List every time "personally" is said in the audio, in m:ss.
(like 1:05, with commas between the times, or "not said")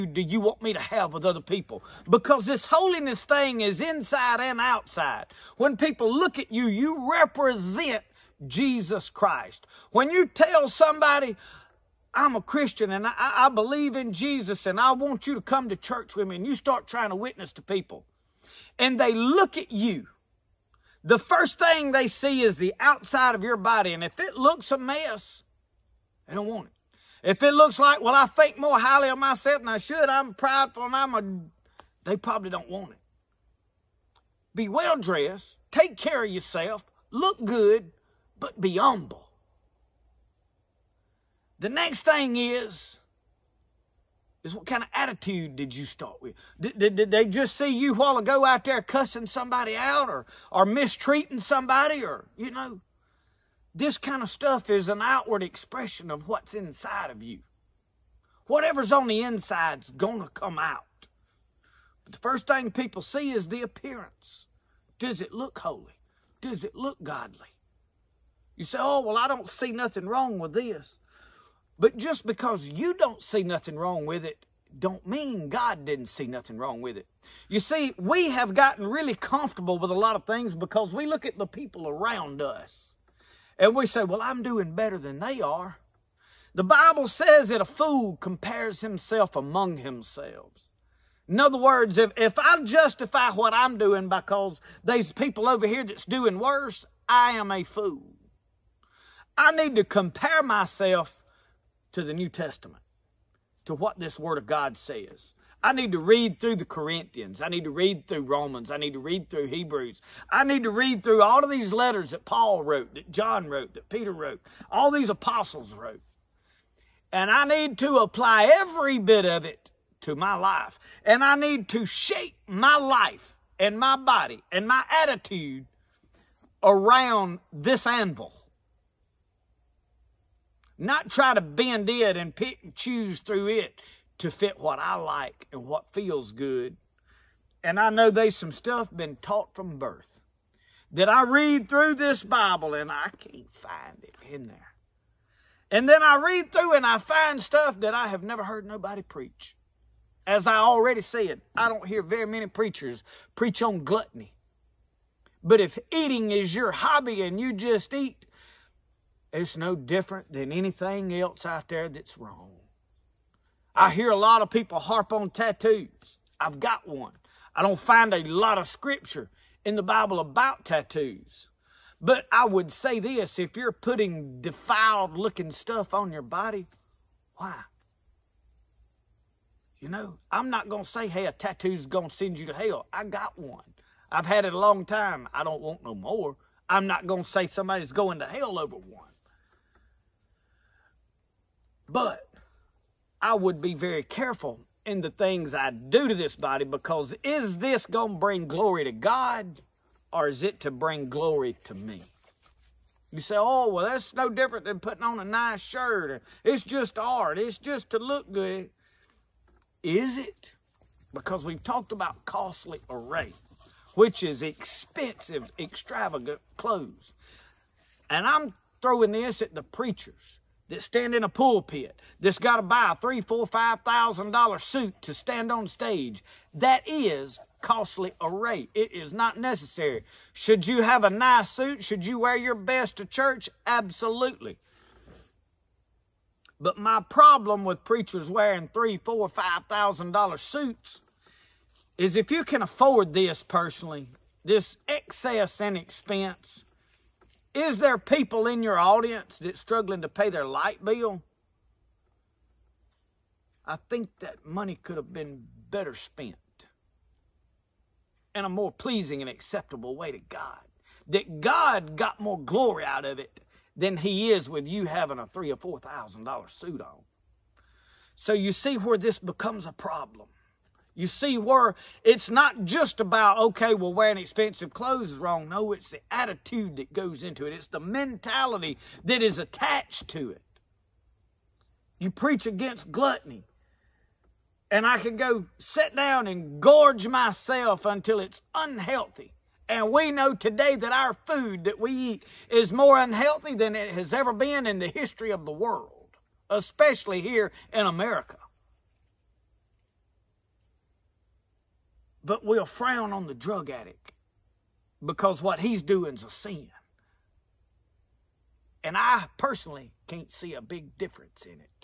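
4:03, 5:09.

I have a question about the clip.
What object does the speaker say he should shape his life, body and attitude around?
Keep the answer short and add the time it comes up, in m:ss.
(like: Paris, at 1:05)
Anvil, at 2:07.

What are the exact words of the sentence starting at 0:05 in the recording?
When people look at you, you represent Jesus Christ.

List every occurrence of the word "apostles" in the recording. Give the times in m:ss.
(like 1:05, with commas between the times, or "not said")
1:55.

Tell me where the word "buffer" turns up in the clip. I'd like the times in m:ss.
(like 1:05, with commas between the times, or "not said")
not said.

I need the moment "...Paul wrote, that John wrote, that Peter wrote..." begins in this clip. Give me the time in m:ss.
1:52.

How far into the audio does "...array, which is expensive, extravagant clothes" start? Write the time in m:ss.
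3:32.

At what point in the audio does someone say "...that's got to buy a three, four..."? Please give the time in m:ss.
3:42.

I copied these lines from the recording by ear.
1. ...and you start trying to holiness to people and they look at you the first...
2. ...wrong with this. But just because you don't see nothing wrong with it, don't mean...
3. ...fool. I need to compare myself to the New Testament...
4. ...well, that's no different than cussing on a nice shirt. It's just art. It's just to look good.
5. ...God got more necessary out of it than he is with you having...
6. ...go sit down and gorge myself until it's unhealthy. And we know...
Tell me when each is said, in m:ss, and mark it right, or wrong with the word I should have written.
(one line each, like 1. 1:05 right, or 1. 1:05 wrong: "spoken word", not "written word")
1. 0:16 wrong: "witness", not "holiness"
2. 1:10 right
3. 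1:37 right
4. 3:23 wrong: "putting", not "cussing"
5. 4:21 wrong: "glory", not "necessary"
6. 4:45 right.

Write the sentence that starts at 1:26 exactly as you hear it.
The Bible says that a fool compares himself among himself.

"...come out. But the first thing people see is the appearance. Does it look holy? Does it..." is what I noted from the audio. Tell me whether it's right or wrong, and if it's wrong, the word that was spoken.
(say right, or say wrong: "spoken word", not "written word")
right.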